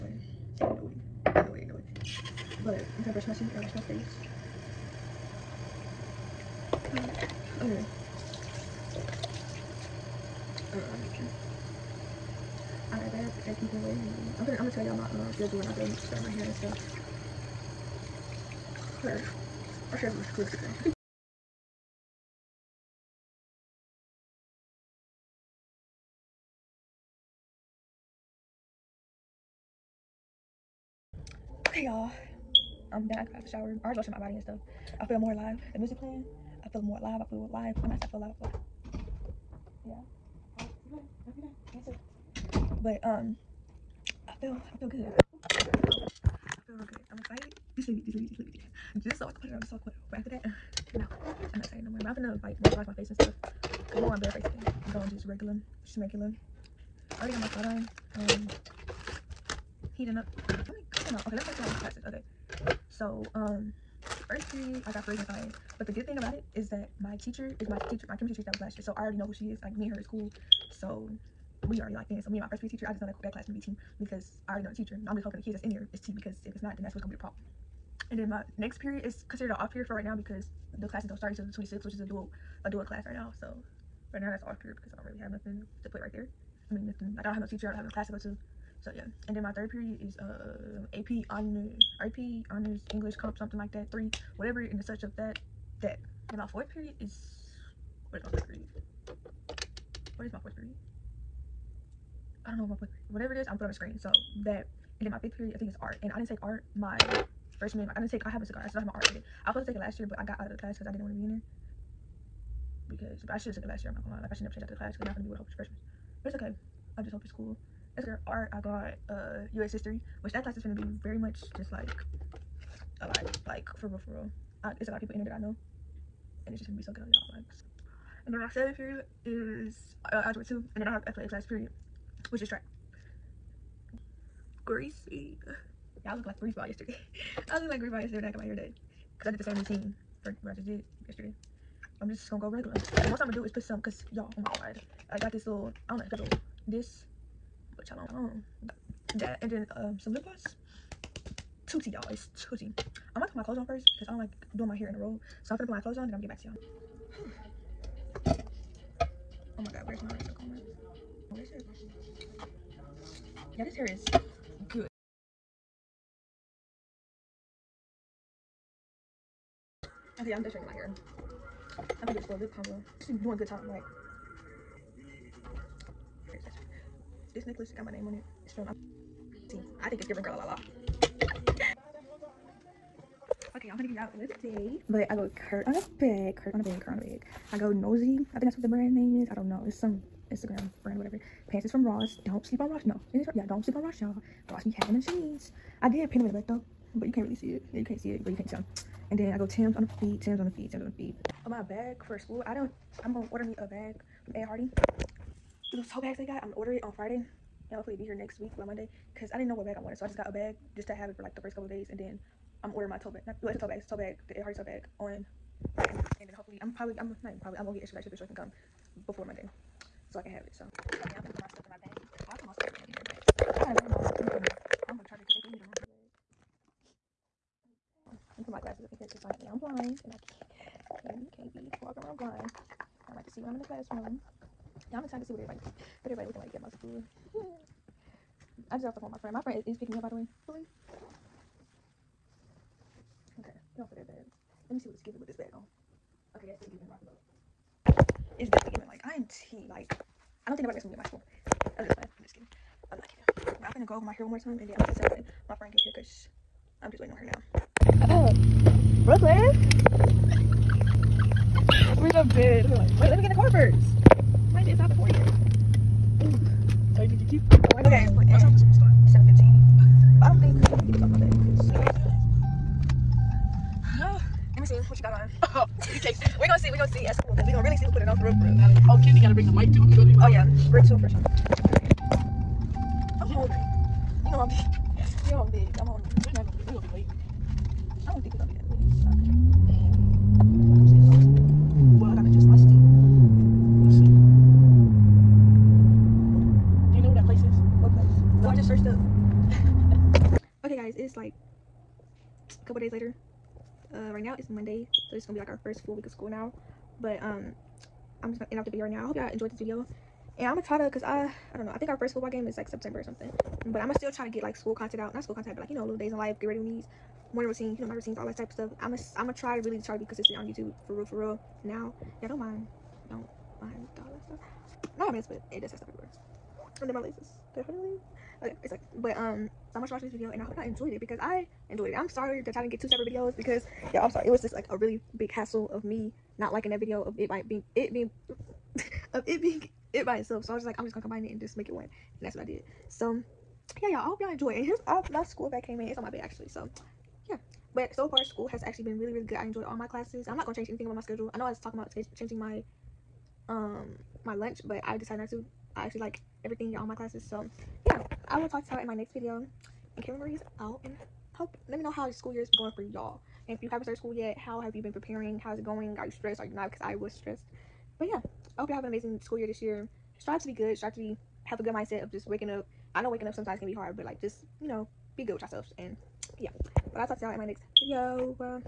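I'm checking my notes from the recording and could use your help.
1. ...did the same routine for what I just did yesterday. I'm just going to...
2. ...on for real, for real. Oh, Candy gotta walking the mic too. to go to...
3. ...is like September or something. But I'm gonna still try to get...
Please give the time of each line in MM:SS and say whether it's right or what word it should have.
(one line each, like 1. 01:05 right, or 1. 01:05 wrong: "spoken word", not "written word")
1. 02:19 right
2. 04:38 wrong: "bring", not "walking"
3. 05:12 right.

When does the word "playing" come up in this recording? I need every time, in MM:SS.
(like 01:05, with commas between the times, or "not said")
00:36, 04:11.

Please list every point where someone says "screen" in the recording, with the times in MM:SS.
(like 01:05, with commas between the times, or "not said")
01:43.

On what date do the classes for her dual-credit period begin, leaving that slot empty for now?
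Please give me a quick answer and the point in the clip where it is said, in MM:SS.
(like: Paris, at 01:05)
The 26th, at 01:21.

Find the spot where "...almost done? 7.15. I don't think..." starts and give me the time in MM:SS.
04:28.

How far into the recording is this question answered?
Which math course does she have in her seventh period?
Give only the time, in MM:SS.
02:10.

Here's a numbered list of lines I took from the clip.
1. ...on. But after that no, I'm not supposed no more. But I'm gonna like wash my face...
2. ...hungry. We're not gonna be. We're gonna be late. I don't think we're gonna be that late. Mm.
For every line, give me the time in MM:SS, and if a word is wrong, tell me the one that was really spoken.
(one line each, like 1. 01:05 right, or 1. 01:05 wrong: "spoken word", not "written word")
1. 00:49 wrong: "excited", not "supposed"
2. 04:45 right.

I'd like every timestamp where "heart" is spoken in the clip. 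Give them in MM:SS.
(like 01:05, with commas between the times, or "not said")
not said.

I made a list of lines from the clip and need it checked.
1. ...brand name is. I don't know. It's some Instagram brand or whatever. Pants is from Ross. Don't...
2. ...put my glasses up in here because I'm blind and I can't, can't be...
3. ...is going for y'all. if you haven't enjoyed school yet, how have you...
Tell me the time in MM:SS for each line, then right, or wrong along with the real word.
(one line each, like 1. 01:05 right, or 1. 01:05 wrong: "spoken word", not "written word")
1. 03:08 right
2. 03:48 right
3. 06:02 wrong: "started", not "enjoyed".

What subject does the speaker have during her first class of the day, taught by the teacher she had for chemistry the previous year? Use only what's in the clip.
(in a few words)
Science.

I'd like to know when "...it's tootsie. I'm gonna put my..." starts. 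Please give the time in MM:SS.
02:32.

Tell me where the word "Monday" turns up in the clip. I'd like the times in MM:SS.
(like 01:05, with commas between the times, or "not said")
03:28, 03:39, 05:04.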